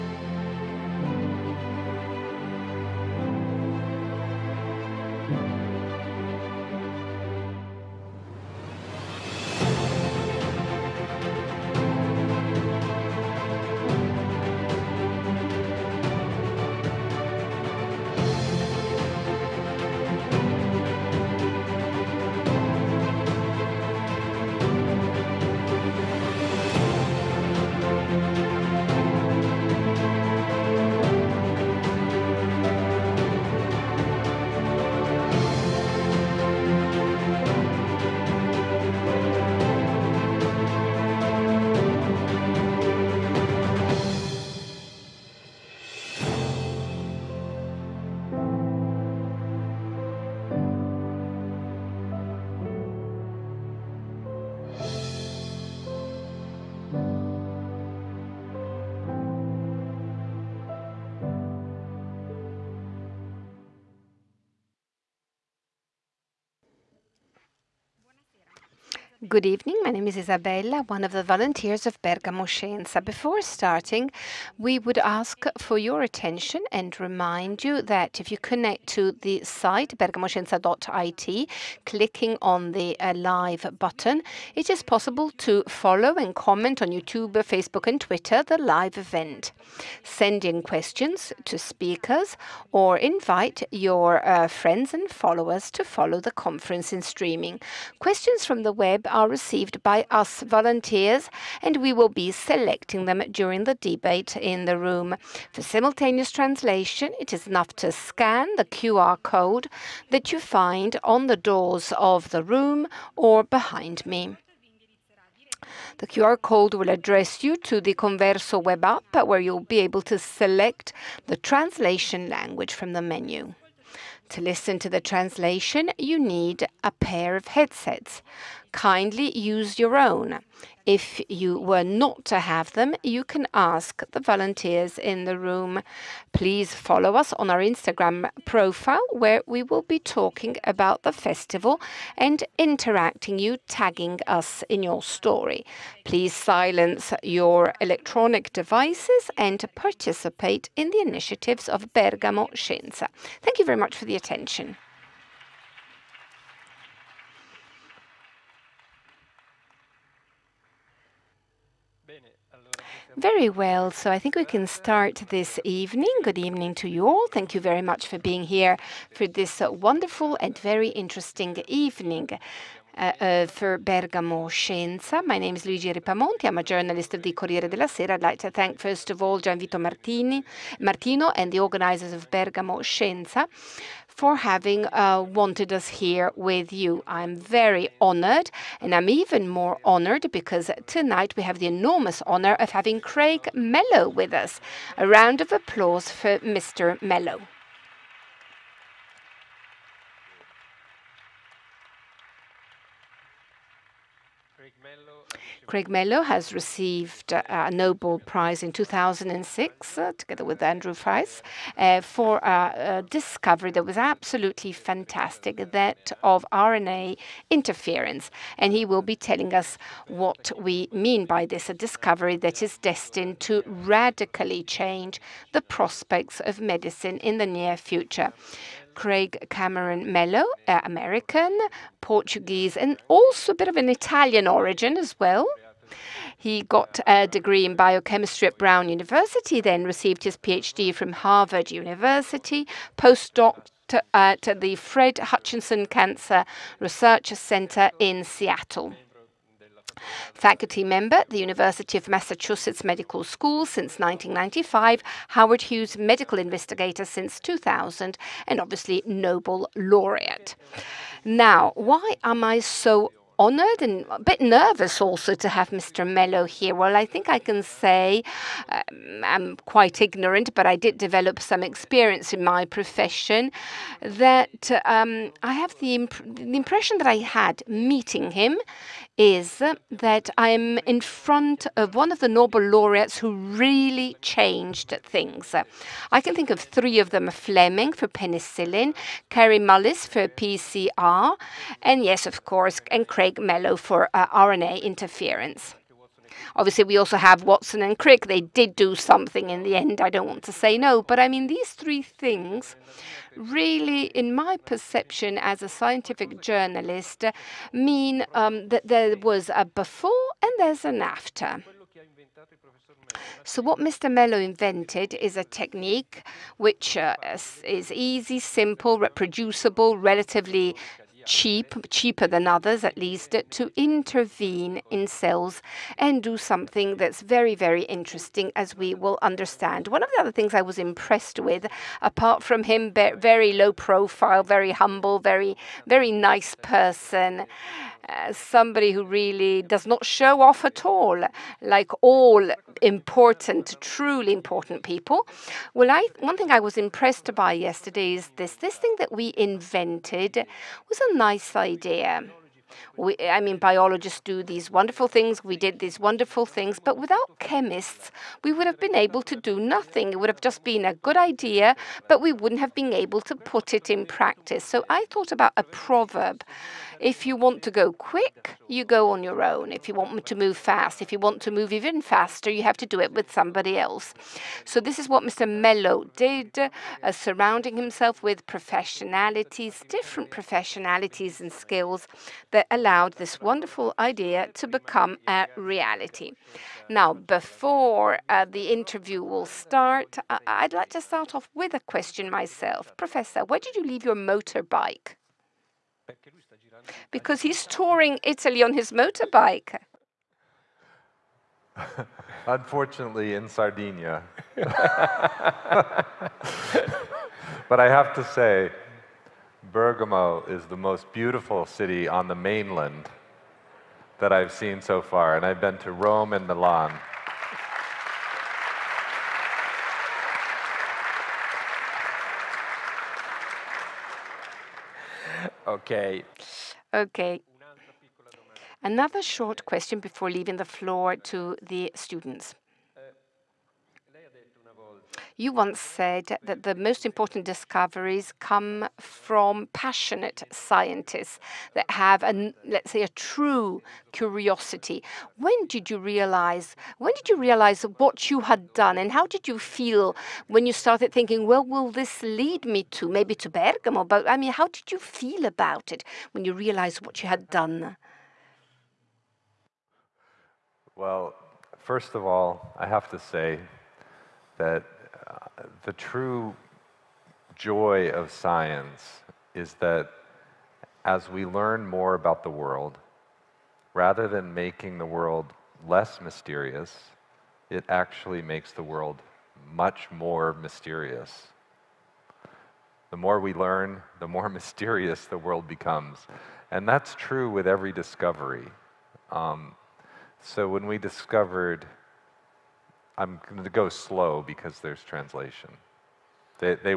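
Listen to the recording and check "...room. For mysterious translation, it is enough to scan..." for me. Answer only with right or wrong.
wrong.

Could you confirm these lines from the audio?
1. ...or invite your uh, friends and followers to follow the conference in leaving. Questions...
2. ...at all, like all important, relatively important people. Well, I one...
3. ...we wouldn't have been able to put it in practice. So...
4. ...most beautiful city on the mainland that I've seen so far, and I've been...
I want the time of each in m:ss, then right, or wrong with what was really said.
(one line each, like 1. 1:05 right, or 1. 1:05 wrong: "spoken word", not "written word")
1. 1:32 wrong: "streaming", not "leaving"
2. 5:40 wrong: "truly", not "relatively"
3. 6:02 right
4. 6:50 right.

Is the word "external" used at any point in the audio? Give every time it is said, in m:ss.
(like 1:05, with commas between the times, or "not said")
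not said.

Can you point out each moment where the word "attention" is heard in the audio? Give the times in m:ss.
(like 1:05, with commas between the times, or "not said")
1:16, 2:34.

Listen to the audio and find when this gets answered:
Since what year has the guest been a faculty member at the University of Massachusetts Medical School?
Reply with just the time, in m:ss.
4:13.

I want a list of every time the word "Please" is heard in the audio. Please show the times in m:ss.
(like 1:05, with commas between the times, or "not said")
2:16, 2:26.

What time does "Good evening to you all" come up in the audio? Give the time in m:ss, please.
2:46.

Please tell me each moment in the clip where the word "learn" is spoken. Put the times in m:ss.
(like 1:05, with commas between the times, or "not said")
7:51, 8:03.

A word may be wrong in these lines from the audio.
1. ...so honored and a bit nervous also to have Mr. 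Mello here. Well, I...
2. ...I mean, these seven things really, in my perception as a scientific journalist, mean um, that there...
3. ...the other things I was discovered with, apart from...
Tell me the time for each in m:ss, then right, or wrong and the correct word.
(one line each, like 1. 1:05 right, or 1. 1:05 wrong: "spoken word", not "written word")
1. 4:22 right
2. 5:01 wrong: "three", not "seven"
3. 5:30 wrong: "impressed", not "discovered".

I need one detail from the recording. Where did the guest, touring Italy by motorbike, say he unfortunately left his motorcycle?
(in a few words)
Sardinia.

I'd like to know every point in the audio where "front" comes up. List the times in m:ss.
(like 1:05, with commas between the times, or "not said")
4:40.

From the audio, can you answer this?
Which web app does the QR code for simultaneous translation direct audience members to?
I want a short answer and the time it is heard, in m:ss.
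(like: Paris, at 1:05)
Converso, at 1:58.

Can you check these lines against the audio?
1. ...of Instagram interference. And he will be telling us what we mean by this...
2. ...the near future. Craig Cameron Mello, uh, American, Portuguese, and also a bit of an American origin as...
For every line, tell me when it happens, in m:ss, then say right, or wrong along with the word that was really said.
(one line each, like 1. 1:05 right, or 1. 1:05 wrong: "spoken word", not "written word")
1. 3:36 wrong: "RNA", not "Instagram"
2. 3:47 wrong: "Italian", not "American".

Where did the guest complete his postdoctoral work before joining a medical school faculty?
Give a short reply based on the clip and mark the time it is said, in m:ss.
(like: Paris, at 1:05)
Fred Hutchinson Cancer Research Center, at 4:04.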